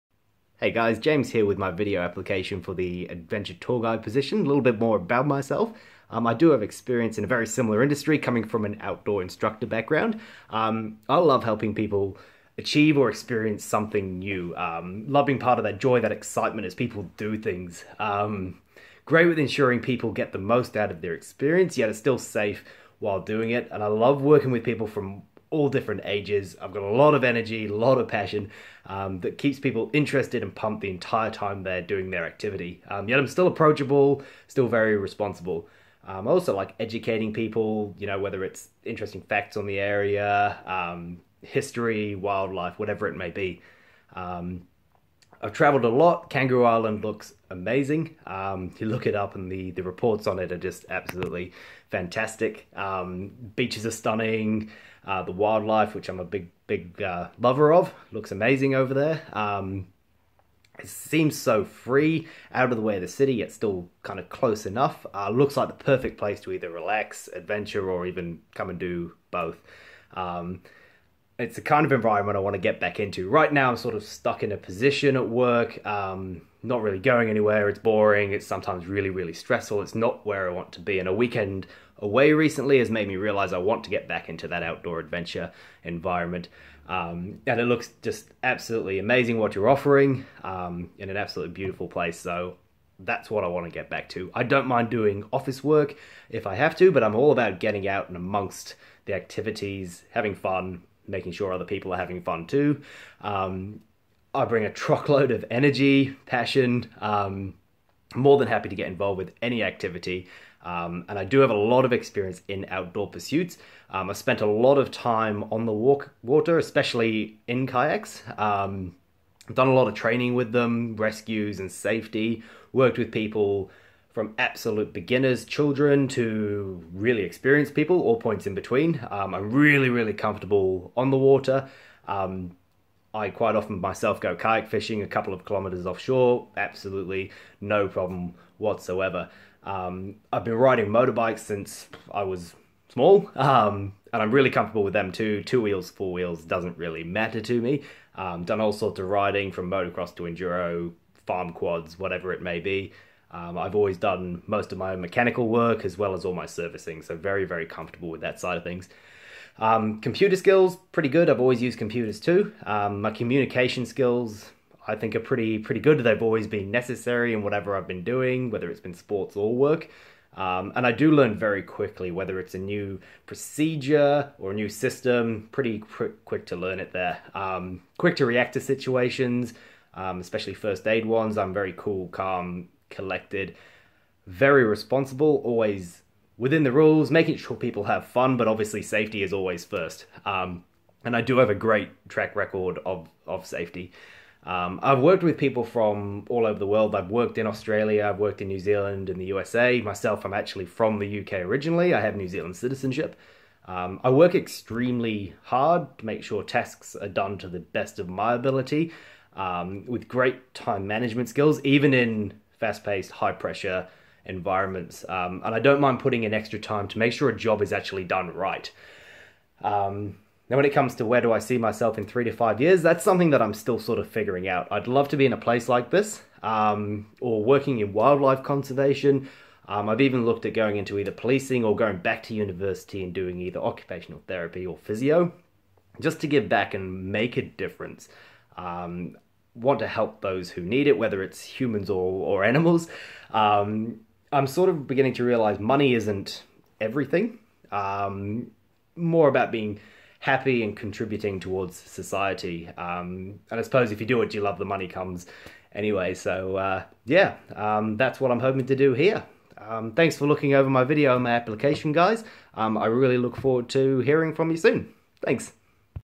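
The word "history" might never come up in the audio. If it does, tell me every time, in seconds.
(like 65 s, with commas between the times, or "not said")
41 s.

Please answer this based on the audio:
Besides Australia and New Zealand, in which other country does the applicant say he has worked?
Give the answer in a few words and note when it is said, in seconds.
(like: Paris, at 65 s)
USA, at 199 s.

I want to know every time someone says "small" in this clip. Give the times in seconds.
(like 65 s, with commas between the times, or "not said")
142 s.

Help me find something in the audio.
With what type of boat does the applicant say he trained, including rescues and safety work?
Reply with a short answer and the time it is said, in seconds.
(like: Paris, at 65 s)
Kayaks, at 117 s.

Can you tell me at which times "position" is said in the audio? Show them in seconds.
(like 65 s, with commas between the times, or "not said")
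4 s, 74 s.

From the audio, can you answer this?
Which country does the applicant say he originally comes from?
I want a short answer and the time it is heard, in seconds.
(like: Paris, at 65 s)
UK, at 201 s.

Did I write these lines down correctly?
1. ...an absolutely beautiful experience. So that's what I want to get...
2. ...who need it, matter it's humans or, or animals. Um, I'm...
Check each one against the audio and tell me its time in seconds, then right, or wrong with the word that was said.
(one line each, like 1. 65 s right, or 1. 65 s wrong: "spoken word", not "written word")
1. 91 s wrong: "place", not "experience"
2. 240 s wrong: "whether", not "matter".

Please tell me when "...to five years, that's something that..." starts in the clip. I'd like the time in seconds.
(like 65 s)
222 s.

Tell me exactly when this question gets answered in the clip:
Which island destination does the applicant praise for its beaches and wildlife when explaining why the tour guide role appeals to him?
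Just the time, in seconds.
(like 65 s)
46 s.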